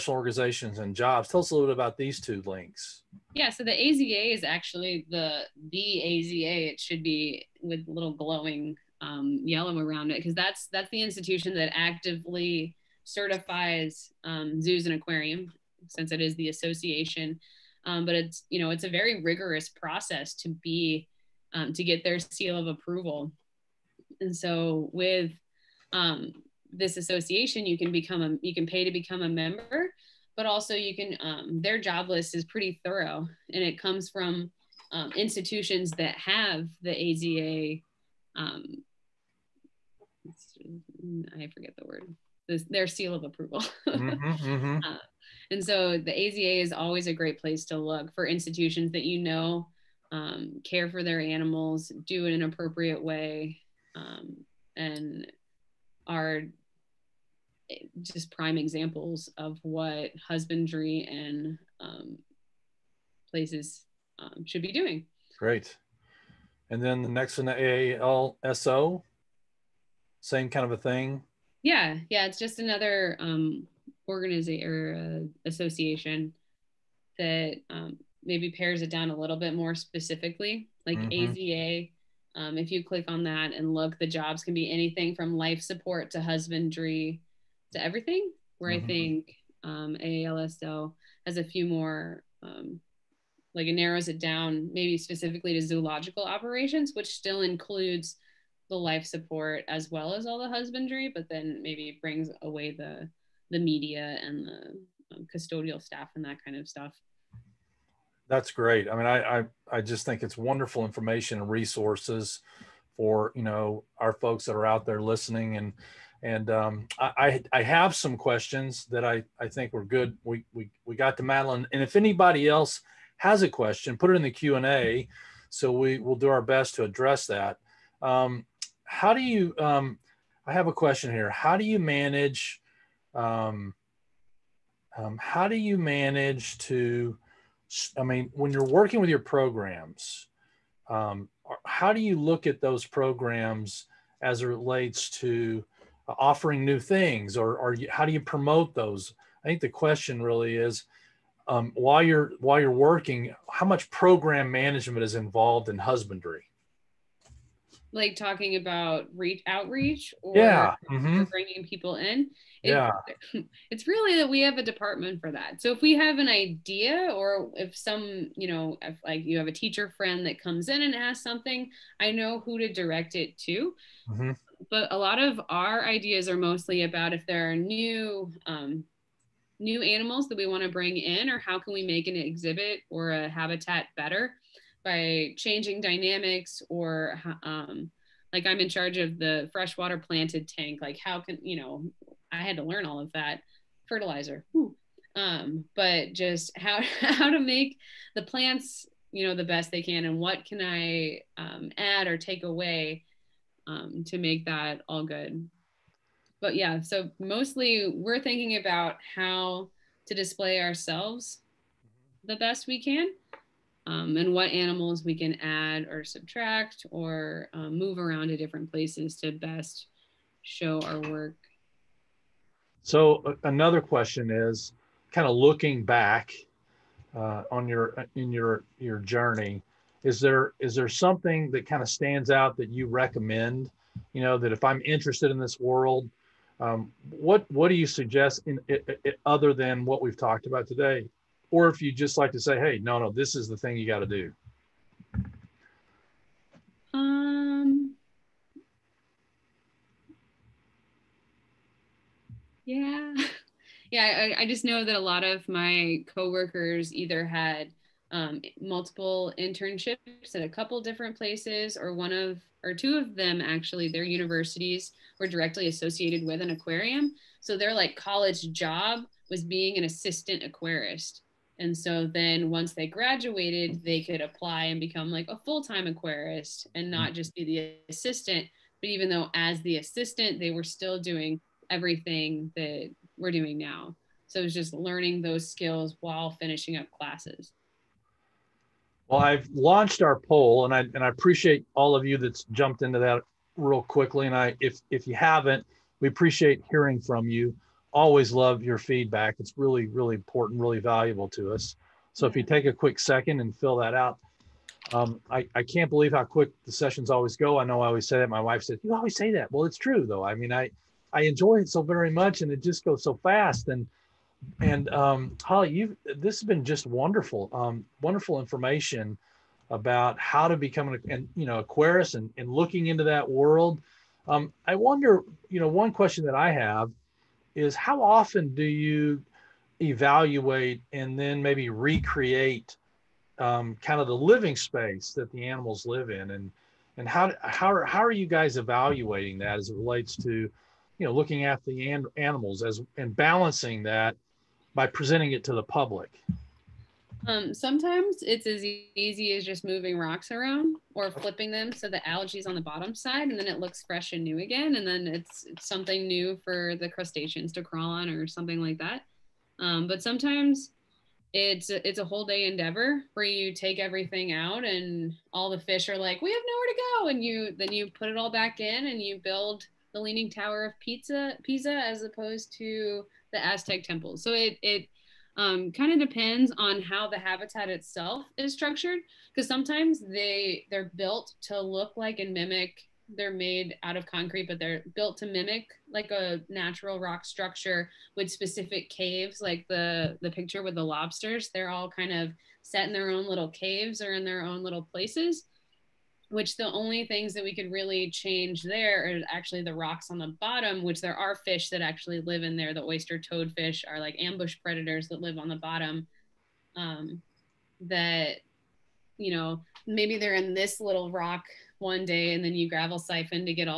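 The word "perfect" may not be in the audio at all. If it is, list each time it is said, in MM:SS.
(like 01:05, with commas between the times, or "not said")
not said.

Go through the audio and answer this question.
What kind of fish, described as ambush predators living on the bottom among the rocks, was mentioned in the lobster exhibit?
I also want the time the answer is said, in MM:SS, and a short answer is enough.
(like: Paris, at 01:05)
oyster toadfish, at 06:42.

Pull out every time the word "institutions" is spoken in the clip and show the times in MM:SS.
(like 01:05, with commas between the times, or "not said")
00:11, 00:35, 00:48.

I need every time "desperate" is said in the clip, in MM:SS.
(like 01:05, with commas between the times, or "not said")
not said.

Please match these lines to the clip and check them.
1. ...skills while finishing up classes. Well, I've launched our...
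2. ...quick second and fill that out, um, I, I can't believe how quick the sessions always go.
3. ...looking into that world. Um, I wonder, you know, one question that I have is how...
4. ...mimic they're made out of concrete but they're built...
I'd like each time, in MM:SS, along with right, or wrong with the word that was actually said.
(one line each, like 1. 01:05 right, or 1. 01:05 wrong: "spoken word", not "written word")
1. 04:45 right
2. 05:02 right
3. 05:22 right
4. 06:22 right.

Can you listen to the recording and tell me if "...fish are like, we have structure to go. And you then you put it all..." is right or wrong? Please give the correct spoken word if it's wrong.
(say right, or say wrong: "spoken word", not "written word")
wrong: "nowhere", not "structure".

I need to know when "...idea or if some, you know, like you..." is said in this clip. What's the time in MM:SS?
02:46.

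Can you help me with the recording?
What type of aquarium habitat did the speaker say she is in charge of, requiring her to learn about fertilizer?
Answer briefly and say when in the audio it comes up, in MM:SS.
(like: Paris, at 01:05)
freshwater planted tank, at 03:09.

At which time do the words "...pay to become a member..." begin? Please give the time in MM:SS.
00:28.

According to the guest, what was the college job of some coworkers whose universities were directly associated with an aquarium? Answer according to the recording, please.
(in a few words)
assistant aquarist.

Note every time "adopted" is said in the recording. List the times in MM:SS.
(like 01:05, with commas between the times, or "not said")
not said.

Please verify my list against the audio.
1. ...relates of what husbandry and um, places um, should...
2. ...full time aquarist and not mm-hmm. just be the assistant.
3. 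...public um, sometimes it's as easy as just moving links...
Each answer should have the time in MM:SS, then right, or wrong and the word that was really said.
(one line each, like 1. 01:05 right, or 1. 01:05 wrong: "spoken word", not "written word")
1. 00:58 wrong: "examples", not "relates"
2. 04:35 right
3. 05:45 wrong: "rocks", not "links".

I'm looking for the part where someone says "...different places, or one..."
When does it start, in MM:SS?
04:20.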